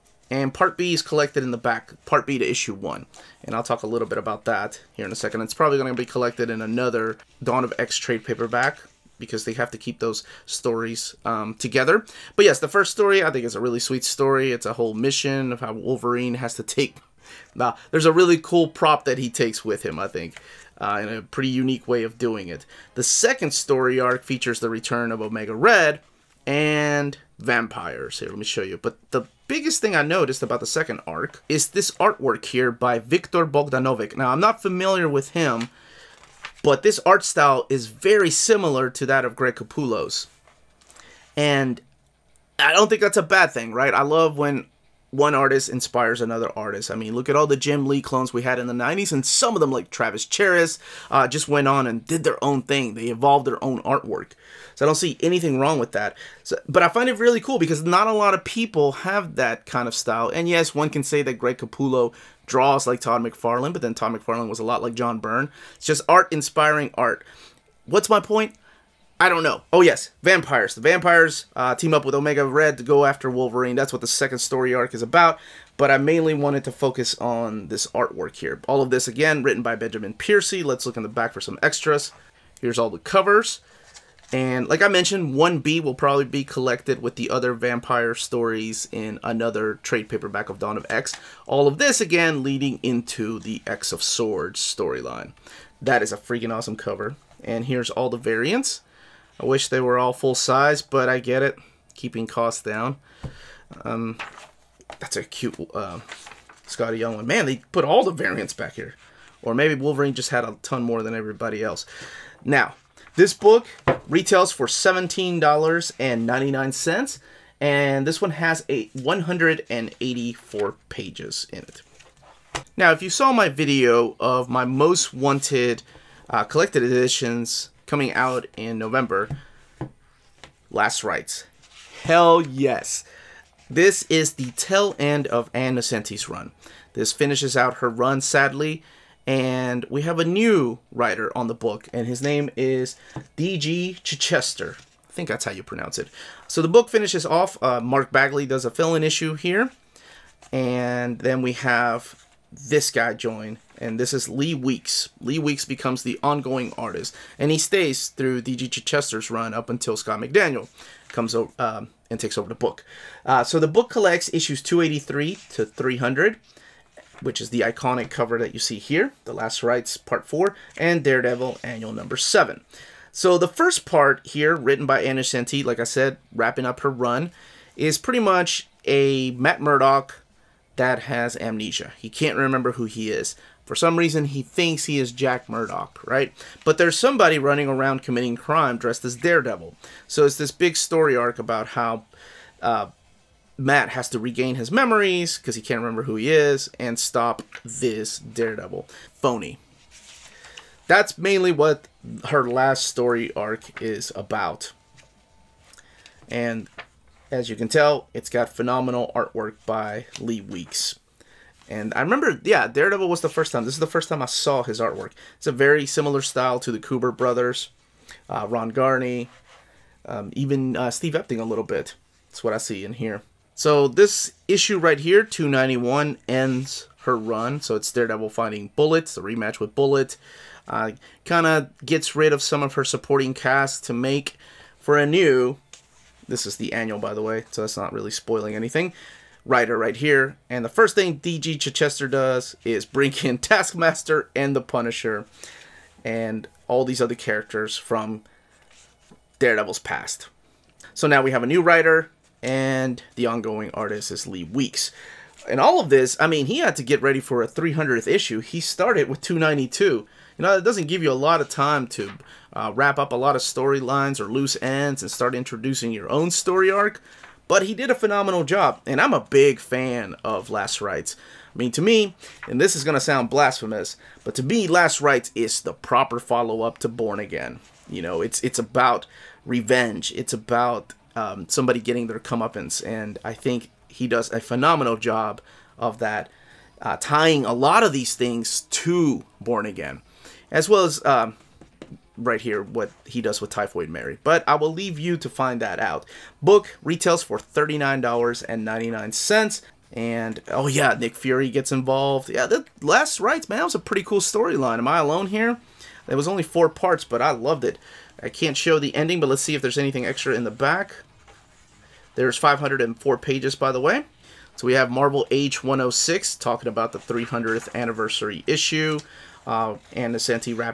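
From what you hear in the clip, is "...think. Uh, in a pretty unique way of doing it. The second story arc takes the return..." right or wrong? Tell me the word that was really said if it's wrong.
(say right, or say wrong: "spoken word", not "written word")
wrong: "features", not "takes".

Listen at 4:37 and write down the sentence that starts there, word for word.
You know, it's it's about revenge.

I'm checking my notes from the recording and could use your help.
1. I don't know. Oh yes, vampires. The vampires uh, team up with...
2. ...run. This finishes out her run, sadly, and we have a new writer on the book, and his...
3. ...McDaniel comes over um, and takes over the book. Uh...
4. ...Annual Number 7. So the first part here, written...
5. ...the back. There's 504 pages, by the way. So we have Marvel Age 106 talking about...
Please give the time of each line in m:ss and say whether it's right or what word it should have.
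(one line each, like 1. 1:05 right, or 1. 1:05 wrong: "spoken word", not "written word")
1. 1:09 right
2. 2:16 right
3. 2:40 right
4. 2:51 right
5. 5:10 right.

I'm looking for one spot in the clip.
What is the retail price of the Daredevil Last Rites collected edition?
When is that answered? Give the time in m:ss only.
4:57.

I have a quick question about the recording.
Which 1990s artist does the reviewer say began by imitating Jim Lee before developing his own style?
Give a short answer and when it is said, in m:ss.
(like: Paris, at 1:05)
Travis Charest, at 0:49.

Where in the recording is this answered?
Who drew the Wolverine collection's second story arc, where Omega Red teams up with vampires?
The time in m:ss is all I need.
0:32.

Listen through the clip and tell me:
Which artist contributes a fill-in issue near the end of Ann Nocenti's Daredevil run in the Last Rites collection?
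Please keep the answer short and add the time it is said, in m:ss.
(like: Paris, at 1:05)
Mark Bagley, at 2:27.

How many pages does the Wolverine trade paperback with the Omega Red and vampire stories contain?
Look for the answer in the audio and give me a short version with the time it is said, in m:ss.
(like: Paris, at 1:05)
184, at 1:58.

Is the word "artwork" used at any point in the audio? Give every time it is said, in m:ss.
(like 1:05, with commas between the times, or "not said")
0:31, 0:53, 1:17, 3:29, 3:34.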